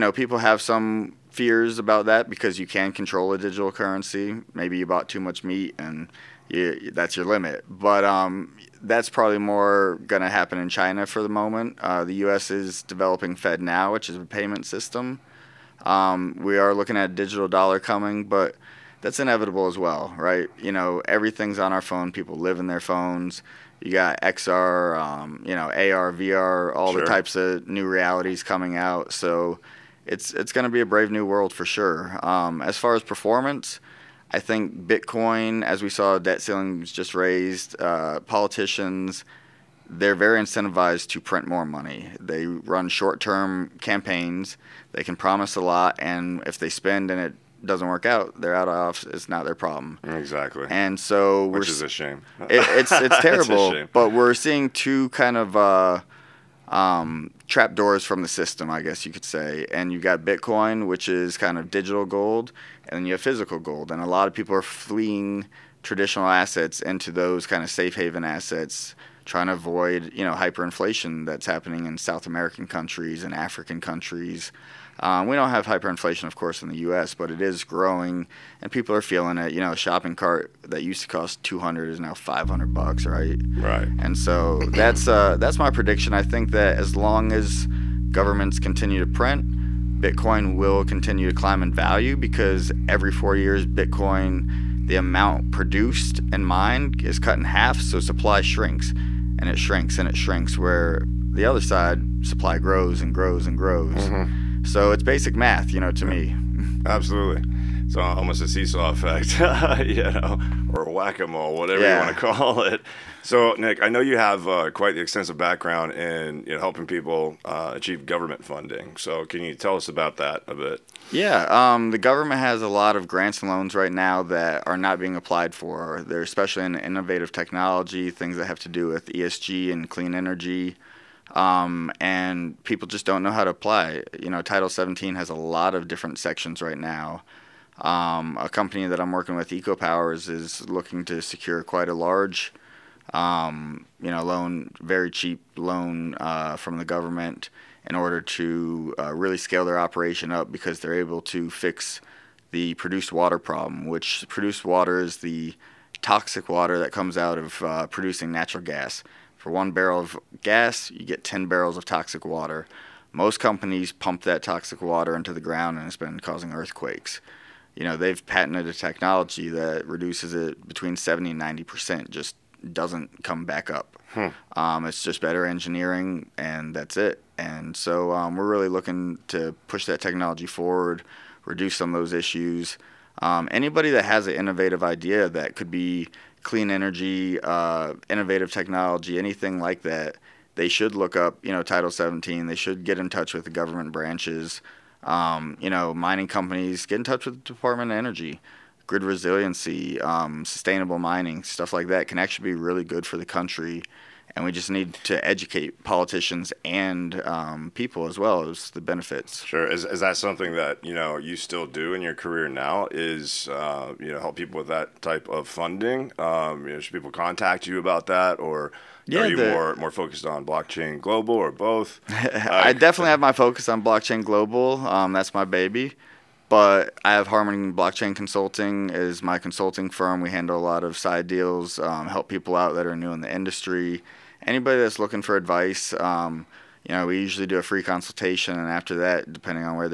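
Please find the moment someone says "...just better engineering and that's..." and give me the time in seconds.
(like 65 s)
175 s.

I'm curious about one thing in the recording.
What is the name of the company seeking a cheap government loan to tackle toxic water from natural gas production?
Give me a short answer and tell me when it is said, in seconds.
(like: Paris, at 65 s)
EcoPowers, at 139 s.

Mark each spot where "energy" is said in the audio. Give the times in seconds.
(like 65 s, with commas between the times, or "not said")
130 s, 186 s, 197 s.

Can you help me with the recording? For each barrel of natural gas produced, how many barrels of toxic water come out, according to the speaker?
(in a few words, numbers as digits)
10.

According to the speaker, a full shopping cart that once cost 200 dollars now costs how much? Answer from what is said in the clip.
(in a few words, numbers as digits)
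$500.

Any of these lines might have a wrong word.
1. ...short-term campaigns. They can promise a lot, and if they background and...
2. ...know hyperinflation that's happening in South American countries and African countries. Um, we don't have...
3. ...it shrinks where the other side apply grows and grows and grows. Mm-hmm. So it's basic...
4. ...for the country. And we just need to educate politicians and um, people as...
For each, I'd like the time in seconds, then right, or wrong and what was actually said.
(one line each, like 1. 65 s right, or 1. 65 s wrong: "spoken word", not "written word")
1. 42 s wrong: "spend", not "background"
2. 70 s right
3. 100 s wrong: "supply", not "apply"
4. 203 s right.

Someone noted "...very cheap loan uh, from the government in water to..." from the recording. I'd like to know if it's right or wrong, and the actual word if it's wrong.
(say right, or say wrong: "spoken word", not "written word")
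wrong: "order", not "water".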